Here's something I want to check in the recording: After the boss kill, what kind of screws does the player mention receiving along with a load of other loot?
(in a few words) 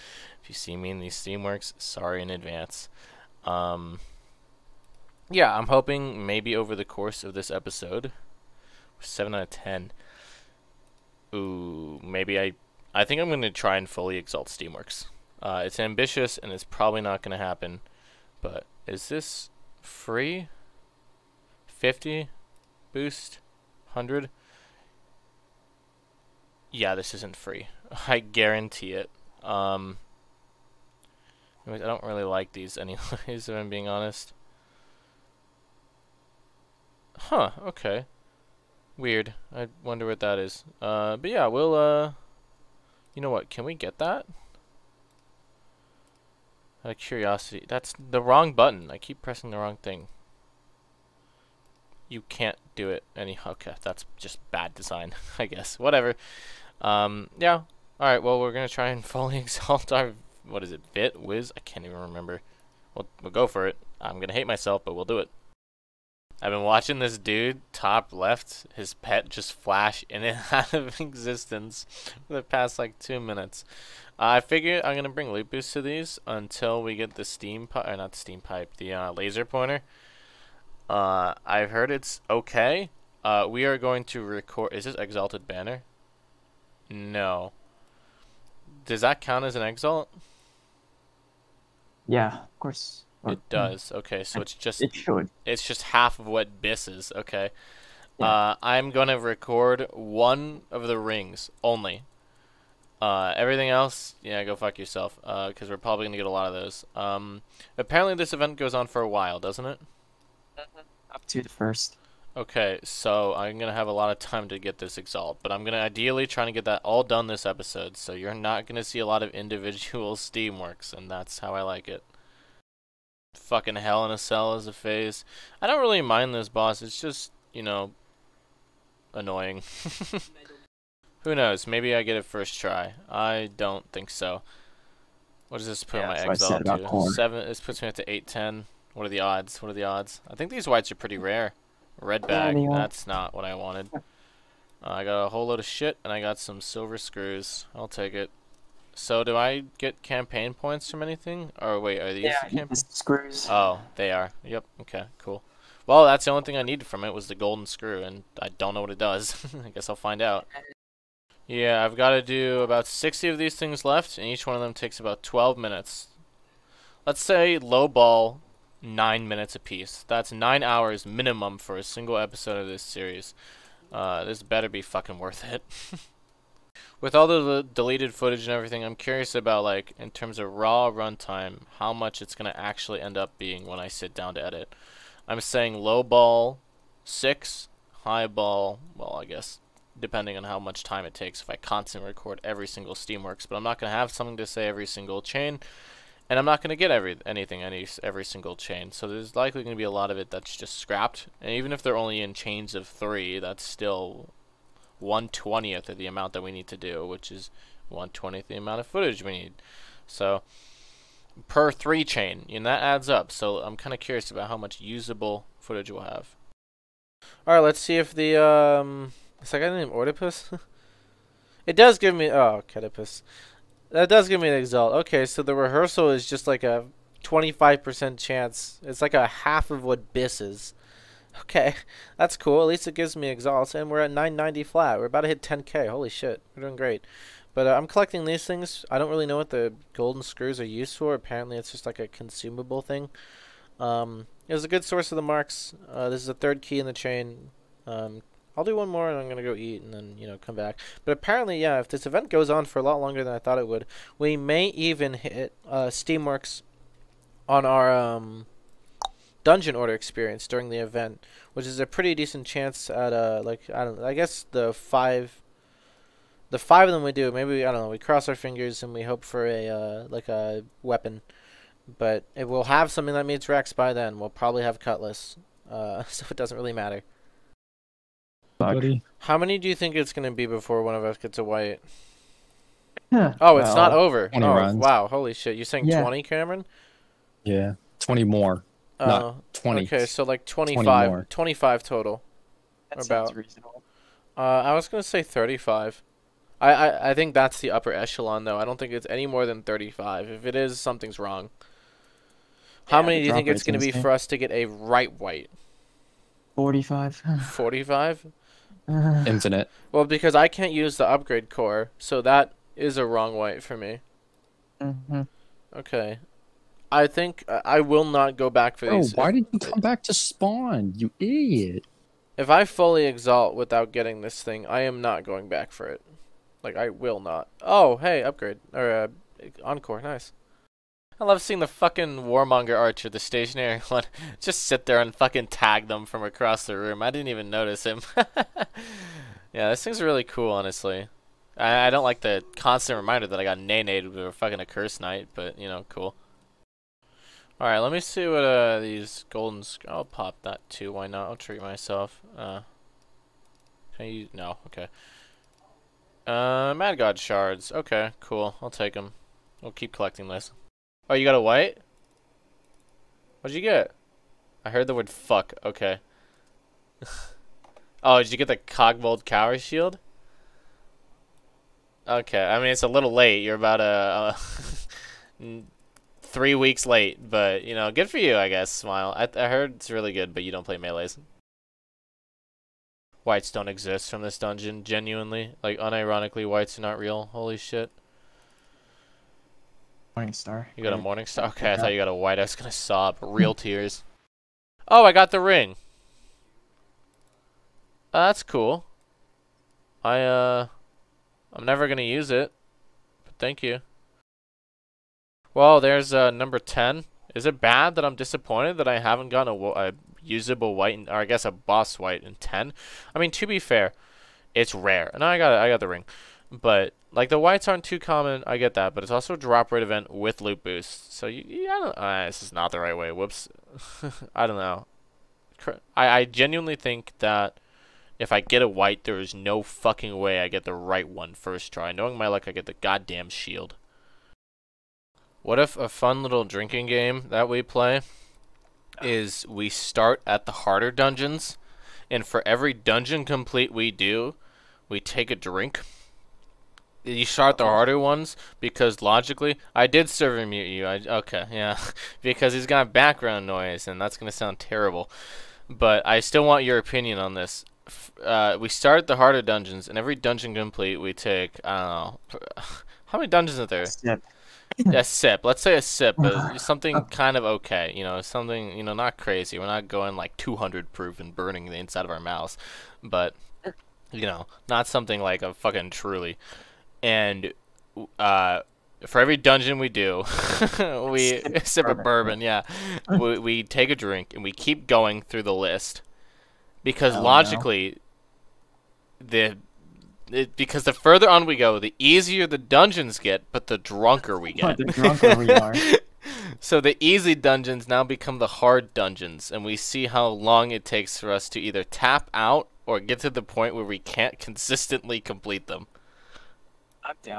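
silver screws.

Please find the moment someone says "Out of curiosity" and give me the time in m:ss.
0:46.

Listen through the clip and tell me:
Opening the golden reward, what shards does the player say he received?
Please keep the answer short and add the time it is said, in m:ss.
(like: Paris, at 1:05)
Mad God shards, at 5:56.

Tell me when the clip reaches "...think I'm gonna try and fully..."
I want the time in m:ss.
0:13.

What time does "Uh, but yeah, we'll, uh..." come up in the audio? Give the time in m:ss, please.
0:40.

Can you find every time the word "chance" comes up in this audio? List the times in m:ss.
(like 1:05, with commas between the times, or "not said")
3:48, 4:22.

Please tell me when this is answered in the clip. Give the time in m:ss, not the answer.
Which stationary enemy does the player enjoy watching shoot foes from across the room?
5:32.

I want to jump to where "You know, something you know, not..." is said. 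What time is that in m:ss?
7:47.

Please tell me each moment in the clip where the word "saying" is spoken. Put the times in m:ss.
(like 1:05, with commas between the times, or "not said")
3:05, 4:45.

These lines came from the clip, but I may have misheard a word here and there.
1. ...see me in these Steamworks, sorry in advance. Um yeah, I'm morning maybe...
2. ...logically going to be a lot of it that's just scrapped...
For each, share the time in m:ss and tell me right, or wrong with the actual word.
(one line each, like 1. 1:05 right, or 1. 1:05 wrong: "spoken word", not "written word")
1. 0:00 wrong: "hoping", not "morning"
2. 3:19 wrong: "likely", not "logically".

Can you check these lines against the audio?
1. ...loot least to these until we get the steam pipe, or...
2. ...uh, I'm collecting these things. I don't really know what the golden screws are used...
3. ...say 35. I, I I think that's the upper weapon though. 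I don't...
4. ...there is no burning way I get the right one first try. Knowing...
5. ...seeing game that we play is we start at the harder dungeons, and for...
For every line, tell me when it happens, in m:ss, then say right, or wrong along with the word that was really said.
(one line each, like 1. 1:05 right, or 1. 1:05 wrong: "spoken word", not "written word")
1. 1:15 wrong: "boost", not "least"
2. 3:57 right
3. 4:55 wrong: "echelon", not "weapon"
4. 7:09 wrong: "fucking", not "burning"
5. 7:16 wrong: "drinking", not "seeing".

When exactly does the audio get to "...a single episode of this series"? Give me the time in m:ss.
2:51.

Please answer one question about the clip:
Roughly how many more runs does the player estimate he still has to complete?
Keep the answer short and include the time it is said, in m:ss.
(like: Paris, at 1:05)
60, at 2:42.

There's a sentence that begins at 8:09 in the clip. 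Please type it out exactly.
the it, because the further on we go, the easier the dungeons get, but the drunker we get.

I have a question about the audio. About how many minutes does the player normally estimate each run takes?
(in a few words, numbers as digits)
12.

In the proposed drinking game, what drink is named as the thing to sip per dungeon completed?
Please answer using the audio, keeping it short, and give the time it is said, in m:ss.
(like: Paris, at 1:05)
bourbon, at 8:01.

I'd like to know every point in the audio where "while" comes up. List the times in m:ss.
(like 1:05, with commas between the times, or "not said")
1:49.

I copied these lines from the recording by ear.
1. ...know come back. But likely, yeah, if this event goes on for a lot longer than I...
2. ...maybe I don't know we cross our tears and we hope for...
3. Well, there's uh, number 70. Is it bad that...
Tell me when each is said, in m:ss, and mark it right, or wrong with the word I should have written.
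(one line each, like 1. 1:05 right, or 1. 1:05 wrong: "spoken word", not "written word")
1. 4:10 wrong: "apparently", not "likely"
2. 4:27 wrong: "fingers", not "tears"
3. 6:45 wrong: "10", not "70".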